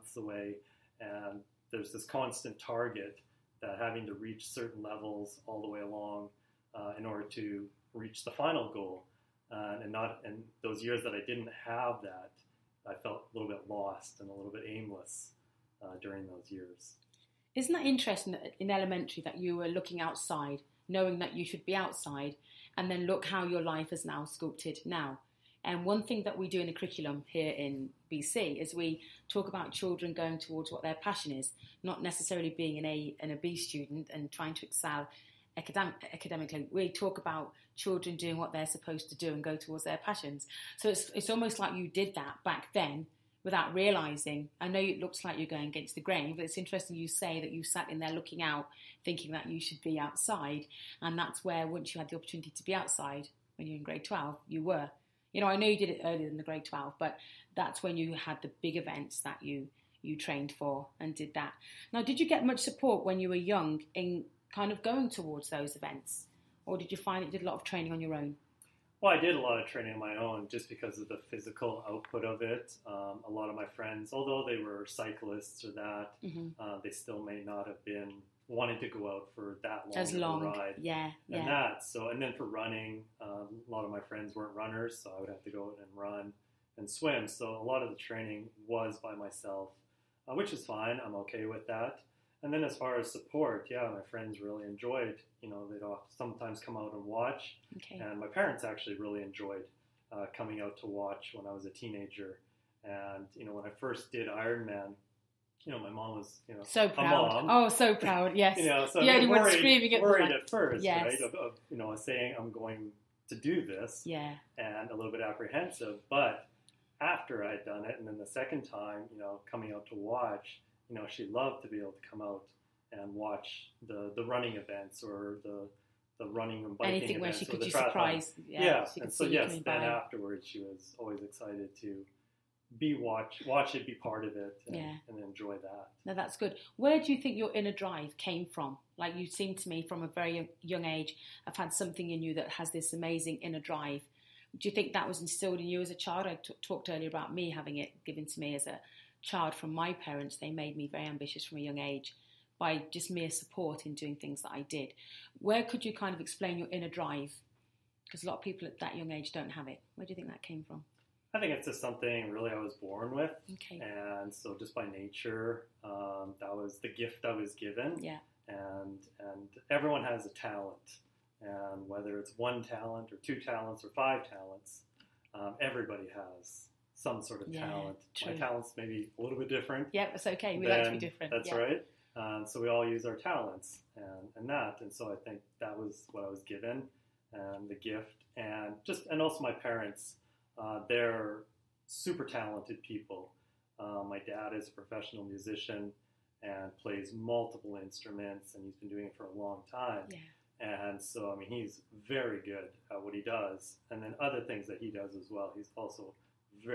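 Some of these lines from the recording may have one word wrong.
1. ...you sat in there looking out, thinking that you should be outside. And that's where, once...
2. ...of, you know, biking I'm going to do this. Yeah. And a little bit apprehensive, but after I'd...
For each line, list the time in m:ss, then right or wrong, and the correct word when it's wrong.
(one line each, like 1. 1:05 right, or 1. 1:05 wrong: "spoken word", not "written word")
1. 0:47 right
2. 1:51 wrong: "saying", not "biking".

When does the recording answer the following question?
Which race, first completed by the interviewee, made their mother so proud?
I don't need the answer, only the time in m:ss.
1:44.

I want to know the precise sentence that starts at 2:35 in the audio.
Where could you kind of explain your inner drive?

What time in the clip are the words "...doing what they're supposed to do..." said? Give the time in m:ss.
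0:38.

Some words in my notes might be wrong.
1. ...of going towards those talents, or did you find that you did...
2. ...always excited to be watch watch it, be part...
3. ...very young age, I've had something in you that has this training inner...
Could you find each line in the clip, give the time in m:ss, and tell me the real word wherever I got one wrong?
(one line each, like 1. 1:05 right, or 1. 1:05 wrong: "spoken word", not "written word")
1. 1:04 wrong: "events", not "talents"
2. 2:10 right
3. 2:20 wrong: "amazing", not "training".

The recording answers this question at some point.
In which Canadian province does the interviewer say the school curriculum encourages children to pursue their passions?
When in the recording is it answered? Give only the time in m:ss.
0:28.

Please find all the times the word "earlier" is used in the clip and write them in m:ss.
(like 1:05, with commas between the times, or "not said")
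0:56, 2:26.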